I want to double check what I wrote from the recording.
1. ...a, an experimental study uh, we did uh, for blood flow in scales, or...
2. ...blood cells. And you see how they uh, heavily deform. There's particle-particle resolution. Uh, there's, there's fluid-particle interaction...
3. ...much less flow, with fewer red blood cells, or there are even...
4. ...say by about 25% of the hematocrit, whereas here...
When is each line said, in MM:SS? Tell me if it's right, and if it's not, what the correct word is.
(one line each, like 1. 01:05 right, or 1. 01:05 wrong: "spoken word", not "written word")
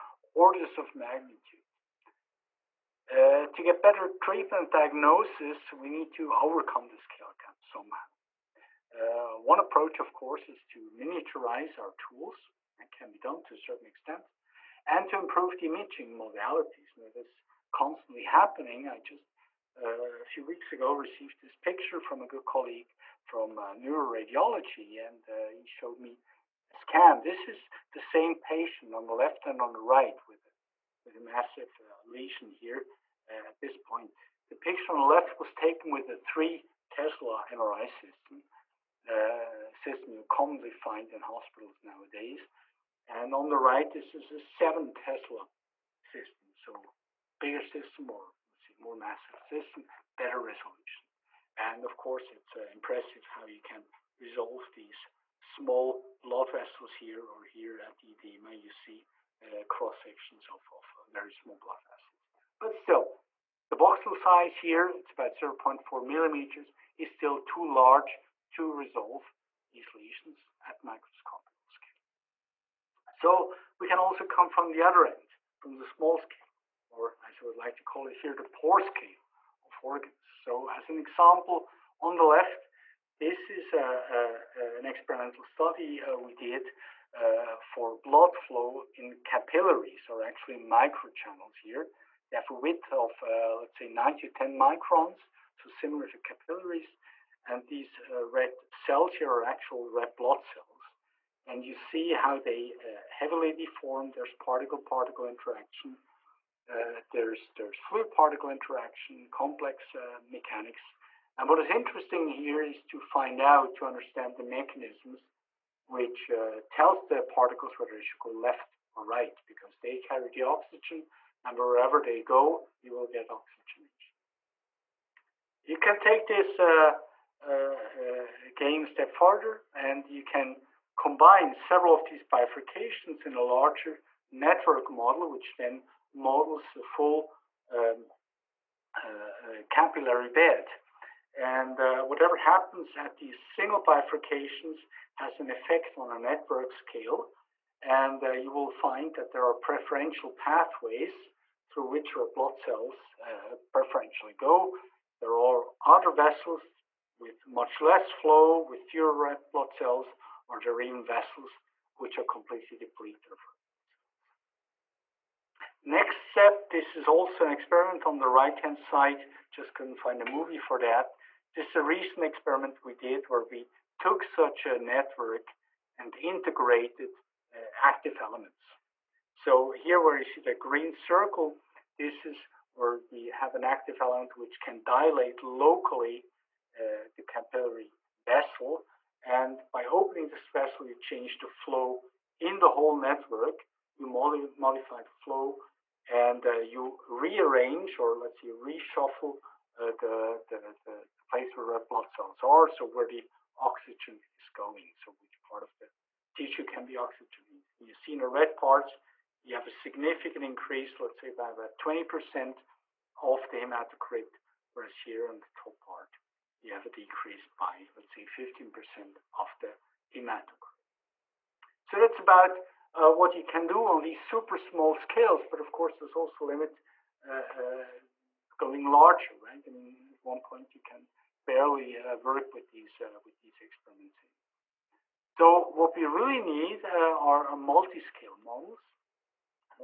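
1. 01:24 wrong: "capillaries", not "scales"
2. 01:40 wrong: "interaction", not "resolution"
3. 02:37 right
4. 03:31 wrong: "20", not "25".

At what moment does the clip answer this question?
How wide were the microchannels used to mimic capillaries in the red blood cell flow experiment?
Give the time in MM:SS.
01:33.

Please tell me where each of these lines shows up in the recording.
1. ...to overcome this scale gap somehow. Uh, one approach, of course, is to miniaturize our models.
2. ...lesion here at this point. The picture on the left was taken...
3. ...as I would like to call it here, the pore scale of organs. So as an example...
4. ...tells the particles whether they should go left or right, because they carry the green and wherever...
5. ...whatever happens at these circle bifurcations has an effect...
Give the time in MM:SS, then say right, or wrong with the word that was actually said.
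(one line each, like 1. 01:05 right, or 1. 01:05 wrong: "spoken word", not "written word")
1. 00:06 wrong: "tools", not "models"
2. 00:32 right
3. 01:17 right
4. 01:56 wrong: "oxygen", not "green"
5. 02:22 wrong: "single", not "circle".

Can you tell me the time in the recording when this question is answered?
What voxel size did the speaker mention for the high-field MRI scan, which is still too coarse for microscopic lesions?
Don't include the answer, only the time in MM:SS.
01:05.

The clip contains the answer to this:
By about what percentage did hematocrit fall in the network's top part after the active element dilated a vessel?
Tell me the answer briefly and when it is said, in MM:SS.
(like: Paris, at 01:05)
15%, at 03:38.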